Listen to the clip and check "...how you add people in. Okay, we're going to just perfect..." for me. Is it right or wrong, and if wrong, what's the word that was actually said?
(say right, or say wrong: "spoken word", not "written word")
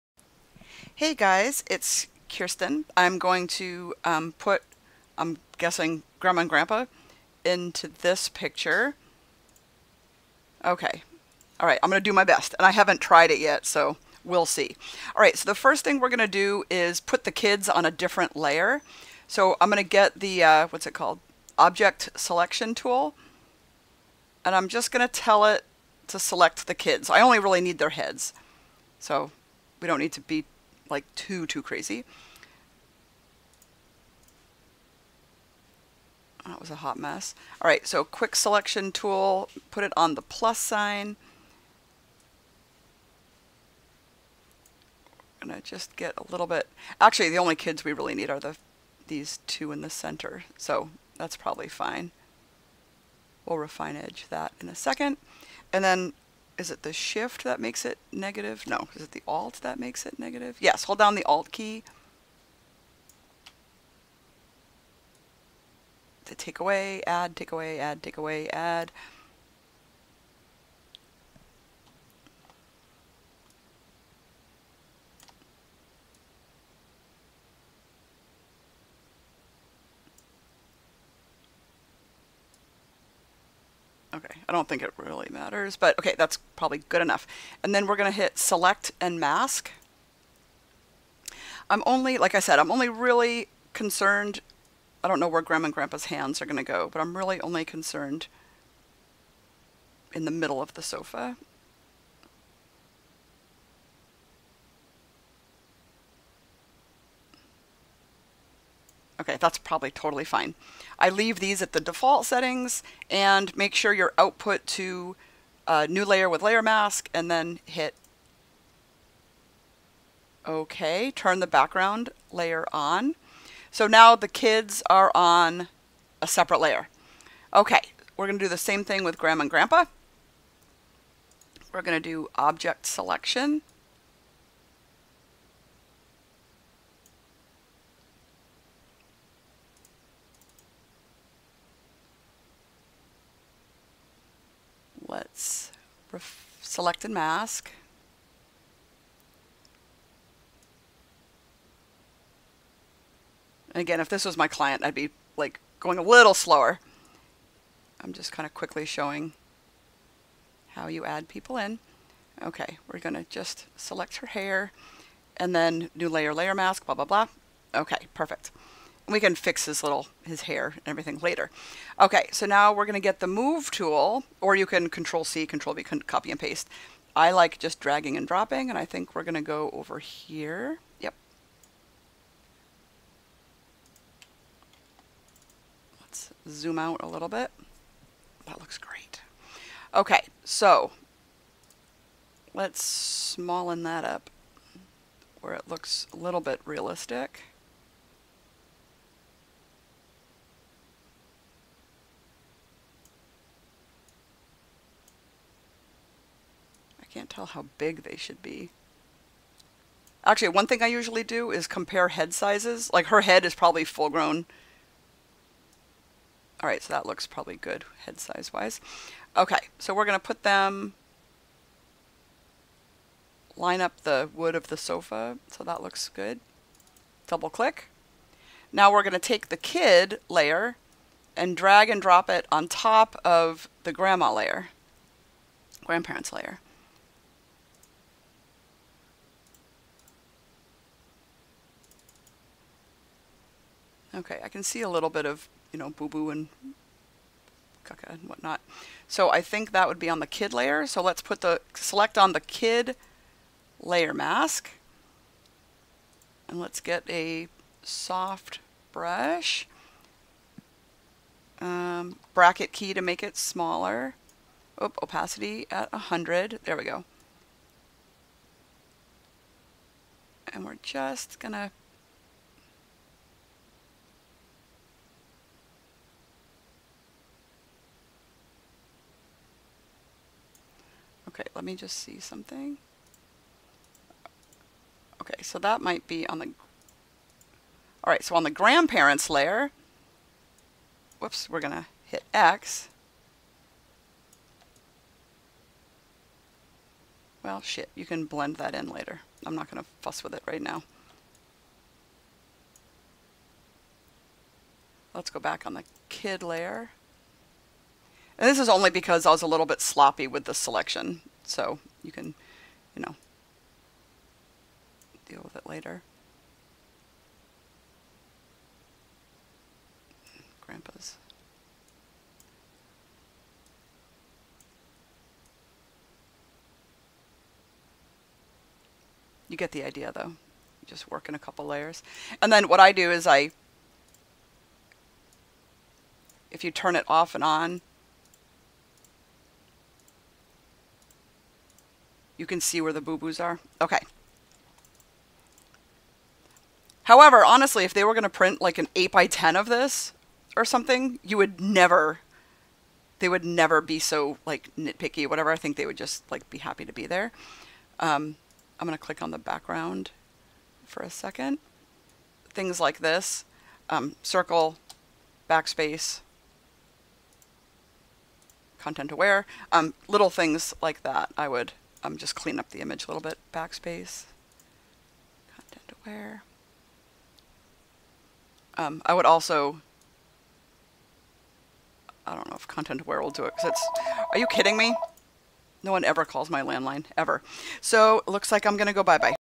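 wrong: "select", not "perfect".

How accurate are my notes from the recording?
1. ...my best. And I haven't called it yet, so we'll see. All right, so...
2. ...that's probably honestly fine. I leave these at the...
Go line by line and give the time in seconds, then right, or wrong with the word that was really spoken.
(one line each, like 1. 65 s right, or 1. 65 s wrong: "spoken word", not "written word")
1. 12 s wrong: "tried", not "called"
2. 109 s wrong: "totally", not "honestly".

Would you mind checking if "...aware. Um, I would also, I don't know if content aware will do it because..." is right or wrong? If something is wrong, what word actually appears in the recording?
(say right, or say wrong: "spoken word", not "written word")
right.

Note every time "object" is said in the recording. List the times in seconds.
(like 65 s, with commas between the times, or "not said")
21 s, 132 s.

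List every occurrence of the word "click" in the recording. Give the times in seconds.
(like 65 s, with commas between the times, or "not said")
227 s, 359 s.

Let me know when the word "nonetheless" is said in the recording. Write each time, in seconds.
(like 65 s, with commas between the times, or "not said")
not said.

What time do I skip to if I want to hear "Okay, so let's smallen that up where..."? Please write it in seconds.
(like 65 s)
189 s.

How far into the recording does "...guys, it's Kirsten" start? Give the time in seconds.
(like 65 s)
1 s.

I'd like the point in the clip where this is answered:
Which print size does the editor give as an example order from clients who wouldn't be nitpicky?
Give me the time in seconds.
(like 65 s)
348 s.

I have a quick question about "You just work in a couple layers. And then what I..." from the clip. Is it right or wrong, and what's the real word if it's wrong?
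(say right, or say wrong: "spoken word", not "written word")
right.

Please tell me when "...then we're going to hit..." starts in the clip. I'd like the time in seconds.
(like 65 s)
87 s.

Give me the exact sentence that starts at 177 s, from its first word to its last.
I like just dragging and dropping, and I think we're going to go over here.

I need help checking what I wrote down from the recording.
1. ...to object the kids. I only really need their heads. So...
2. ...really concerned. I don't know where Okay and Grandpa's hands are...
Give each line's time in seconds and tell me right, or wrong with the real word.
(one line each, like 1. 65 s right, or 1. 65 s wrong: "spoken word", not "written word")
1. 26 s wrong: "select", not "object"
2. 92 s wrong: "Grandma", not "Okay".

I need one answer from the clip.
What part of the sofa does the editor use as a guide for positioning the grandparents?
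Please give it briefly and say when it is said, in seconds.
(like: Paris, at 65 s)
The wood, at 224 s.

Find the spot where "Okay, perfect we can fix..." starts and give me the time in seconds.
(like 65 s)
167 s.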